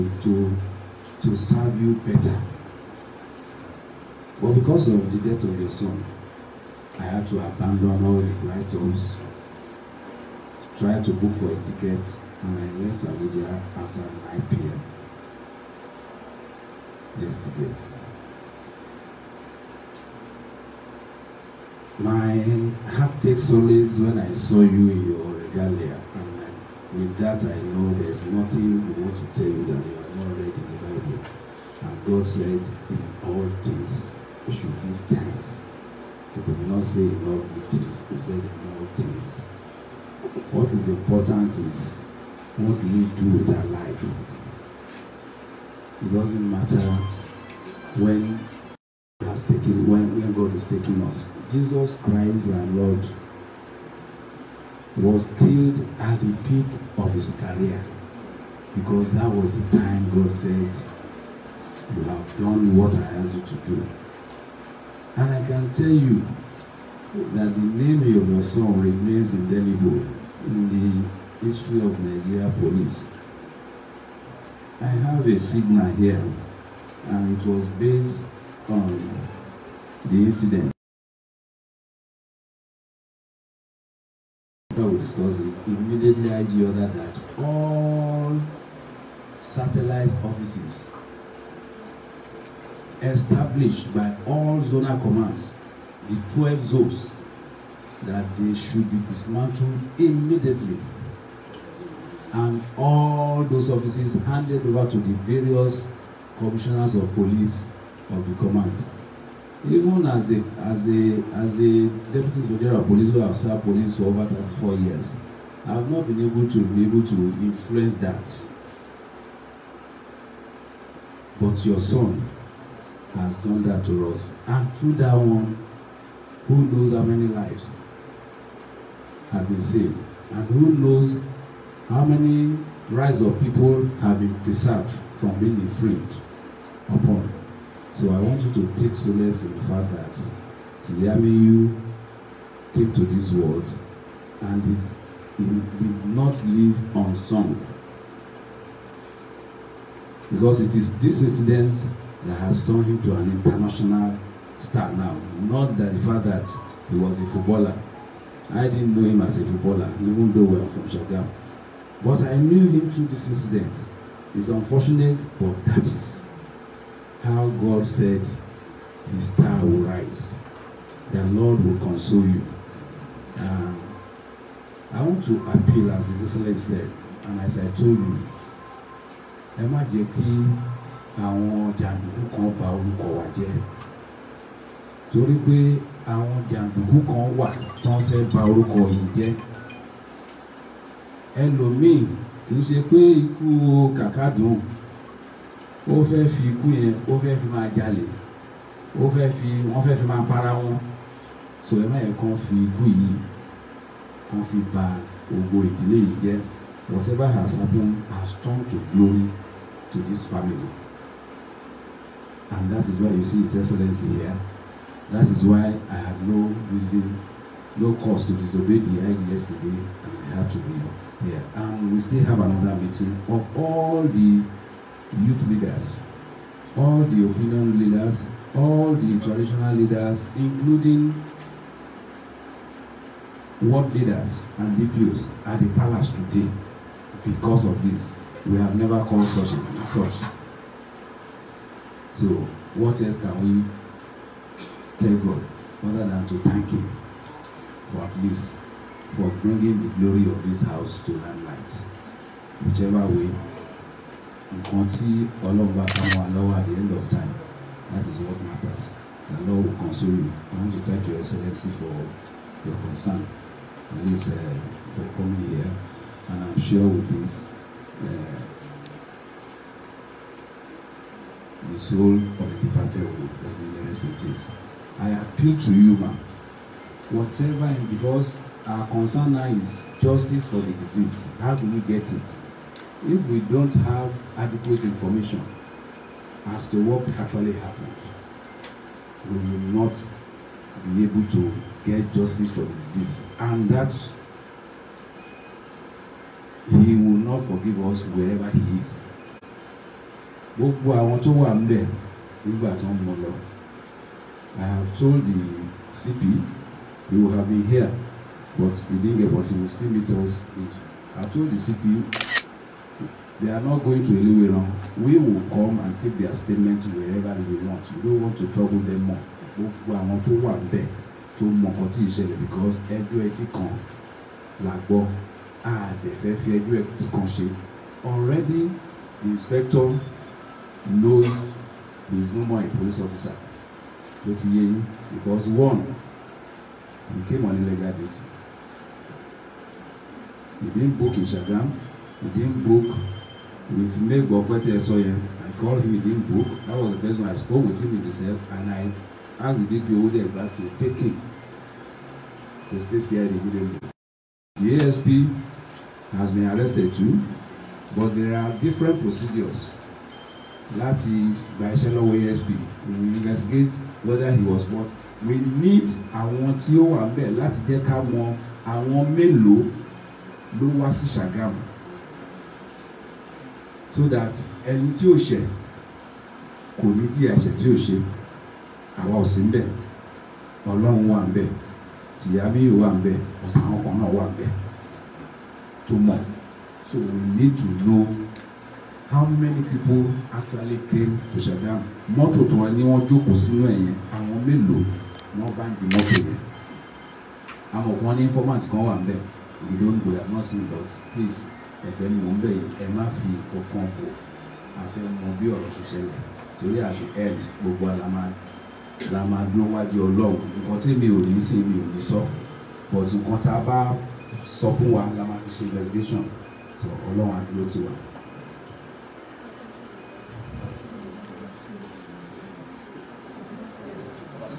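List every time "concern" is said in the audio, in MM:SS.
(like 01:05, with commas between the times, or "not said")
04:22, 04:38.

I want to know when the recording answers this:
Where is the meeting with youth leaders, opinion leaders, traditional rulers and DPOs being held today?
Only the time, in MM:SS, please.
03:55.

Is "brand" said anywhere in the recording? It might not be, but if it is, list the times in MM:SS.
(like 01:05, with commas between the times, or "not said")
not said.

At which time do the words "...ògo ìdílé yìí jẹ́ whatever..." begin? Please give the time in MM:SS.
03:25.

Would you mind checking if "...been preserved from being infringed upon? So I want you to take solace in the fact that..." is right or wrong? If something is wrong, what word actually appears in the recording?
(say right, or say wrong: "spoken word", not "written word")
right.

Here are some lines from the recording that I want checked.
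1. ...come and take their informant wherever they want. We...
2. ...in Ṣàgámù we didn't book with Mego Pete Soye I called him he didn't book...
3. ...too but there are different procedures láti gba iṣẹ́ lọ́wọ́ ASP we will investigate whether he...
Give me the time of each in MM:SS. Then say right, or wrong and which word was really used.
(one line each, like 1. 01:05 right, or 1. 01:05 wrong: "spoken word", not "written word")
1. 05:15 wrong: "statement", not "informant"
2. 05:41 right
3. 05:56 right.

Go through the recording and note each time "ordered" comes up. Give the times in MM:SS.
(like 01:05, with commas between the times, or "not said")
01:26.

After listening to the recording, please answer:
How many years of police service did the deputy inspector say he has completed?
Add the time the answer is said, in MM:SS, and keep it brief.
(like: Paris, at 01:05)
34 years, at 01:54.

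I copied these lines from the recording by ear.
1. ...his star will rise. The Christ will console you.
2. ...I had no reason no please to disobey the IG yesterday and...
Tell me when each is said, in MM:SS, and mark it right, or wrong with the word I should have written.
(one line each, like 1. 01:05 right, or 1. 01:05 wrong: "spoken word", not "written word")
1. 02:49 wrong: "Lord", not "Christ"
2. 03:35 wrong: "cause", not "please".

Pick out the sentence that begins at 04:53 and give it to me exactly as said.
And that he will not forgive us wherever he is.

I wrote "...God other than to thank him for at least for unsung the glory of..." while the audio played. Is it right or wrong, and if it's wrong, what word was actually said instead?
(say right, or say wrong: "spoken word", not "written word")
wrong: "bringing", not "unsung".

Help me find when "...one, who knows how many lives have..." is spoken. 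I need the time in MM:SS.
02:05.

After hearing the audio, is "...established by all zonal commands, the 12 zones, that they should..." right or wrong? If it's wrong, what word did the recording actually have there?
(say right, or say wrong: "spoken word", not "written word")
right.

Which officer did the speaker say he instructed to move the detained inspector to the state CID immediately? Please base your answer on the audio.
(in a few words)
DPO Odegba.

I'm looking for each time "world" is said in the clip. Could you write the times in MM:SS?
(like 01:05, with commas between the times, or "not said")
02:23, 03:53.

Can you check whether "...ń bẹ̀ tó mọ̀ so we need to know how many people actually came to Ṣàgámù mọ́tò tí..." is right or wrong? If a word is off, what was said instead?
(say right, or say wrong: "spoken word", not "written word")
right.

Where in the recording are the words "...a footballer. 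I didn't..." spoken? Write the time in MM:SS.
02:37.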